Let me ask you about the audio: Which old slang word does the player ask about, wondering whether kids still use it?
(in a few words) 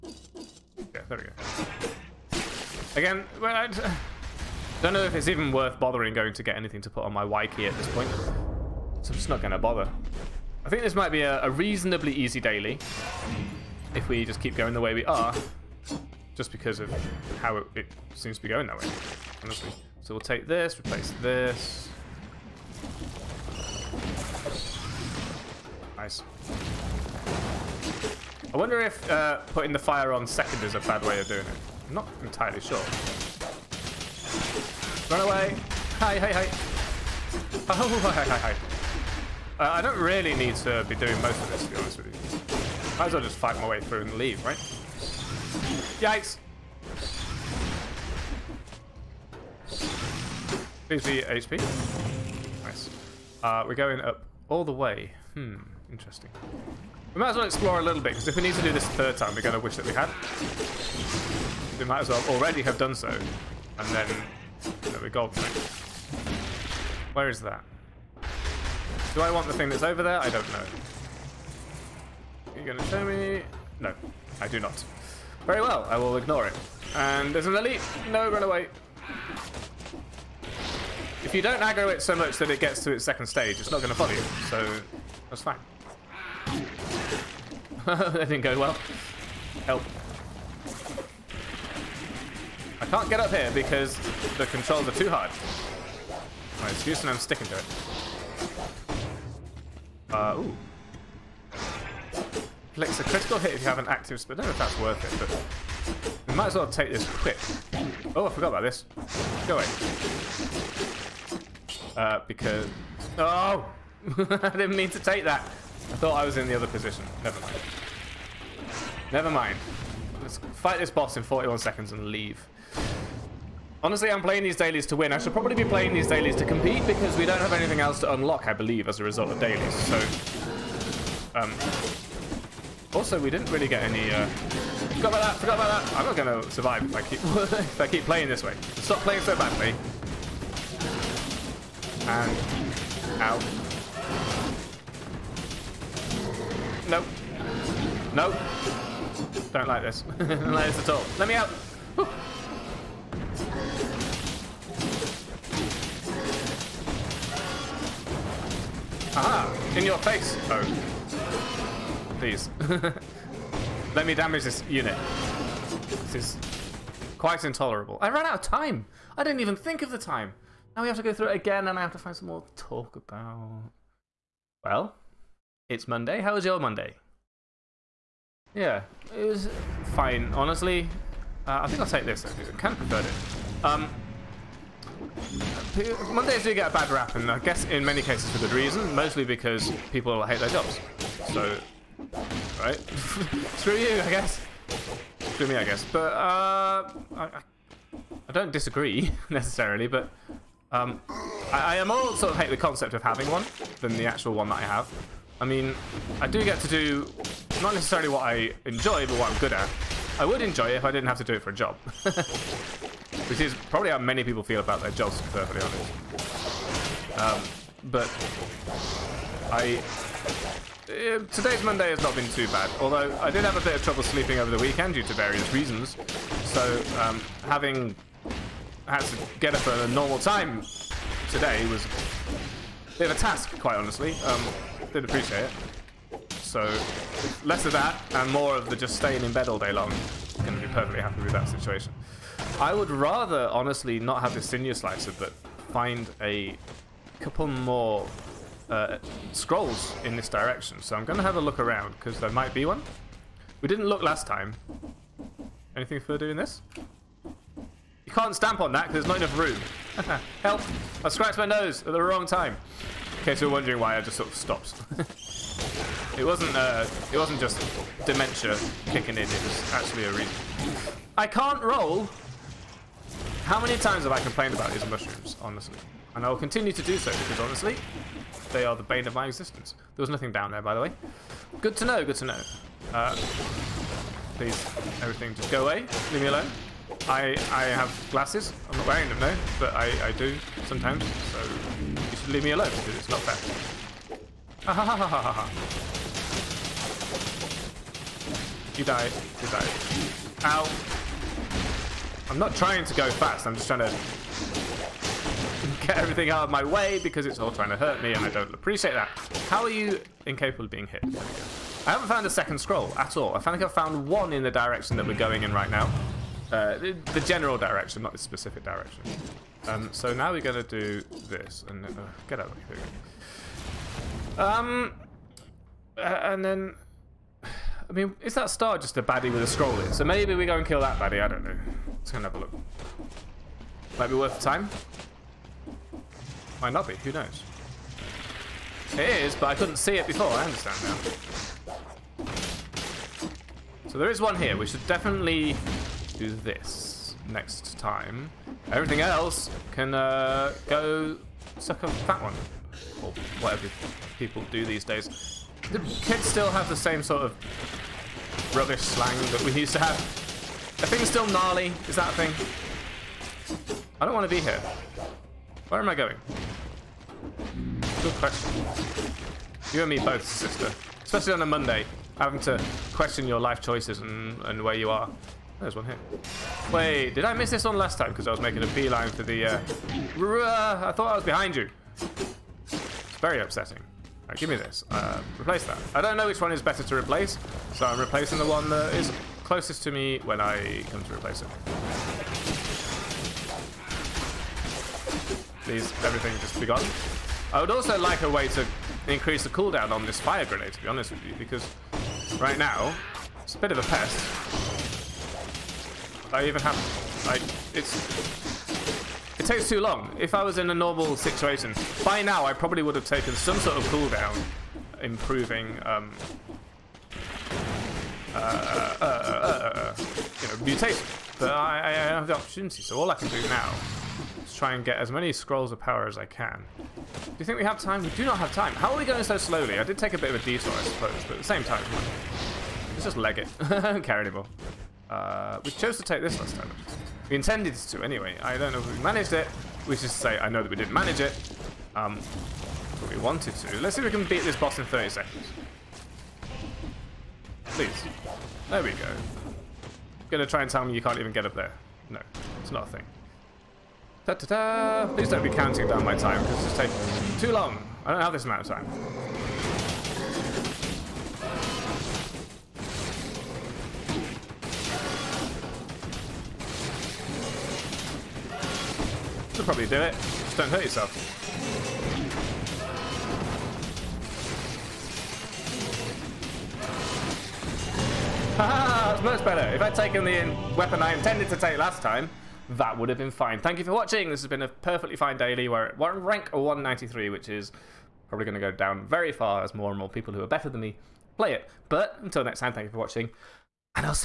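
Gnarly.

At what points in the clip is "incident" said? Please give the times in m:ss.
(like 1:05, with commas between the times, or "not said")
not said.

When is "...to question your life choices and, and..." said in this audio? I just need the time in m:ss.
6:12.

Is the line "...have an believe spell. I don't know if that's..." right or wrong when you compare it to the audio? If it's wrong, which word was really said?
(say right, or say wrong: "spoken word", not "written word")
wrong: "active", not "believe".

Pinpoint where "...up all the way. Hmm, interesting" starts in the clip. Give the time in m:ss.
0:53.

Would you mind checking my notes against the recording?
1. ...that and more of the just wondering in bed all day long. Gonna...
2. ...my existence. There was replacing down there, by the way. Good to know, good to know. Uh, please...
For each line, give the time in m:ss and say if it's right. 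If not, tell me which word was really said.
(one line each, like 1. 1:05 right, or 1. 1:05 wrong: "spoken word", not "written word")
1. 3:57 wrong: "staying", not "wondering"
2. 4:39 wrong: "nothing", not "replacing".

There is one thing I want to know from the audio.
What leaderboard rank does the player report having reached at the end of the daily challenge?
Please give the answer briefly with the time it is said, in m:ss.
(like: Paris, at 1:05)
193, at 8:06.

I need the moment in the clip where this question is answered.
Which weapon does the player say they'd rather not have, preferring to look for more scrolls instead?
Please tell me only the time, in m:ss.
4:04.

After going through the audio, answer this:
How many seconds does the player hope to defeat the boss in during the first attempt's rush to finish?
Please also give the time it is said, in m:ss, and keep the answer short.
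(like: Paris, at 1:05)
41, at 2:01.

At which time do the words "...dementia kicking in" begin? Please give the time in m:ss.
4:28.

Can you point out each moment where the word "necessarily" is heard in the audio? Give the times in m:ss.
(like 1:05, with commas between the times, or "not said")
3:19, 3:27.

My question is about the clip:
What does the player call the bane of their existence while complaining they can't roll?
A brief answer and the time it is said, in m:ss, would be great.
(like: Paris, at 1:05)
Mushrooms, at 4:34.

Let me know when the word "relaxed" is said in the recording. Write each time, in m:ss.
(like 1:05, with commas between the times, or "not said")
not said.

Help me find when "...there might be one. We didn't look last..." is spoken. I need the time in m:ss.
4:12.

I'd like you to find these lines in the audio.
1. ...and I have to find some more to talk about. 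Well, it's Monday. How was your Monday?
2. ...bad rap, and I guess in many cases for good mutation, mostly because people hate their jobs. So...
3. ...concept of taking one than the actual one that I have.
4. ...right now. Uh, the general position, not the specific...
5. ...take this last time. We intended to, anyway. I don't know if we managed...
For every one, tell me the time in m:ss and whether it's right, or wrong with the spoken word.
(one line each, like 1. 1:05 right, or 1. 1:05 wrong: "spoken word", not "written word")
1. 2:51 right
2. 3:06 wrong: "reason", not "mutation"
3. 3:22 wrong: "having", not "taking"
4. 5:15 wrong: "direction", not "position"
5. 7:16 right.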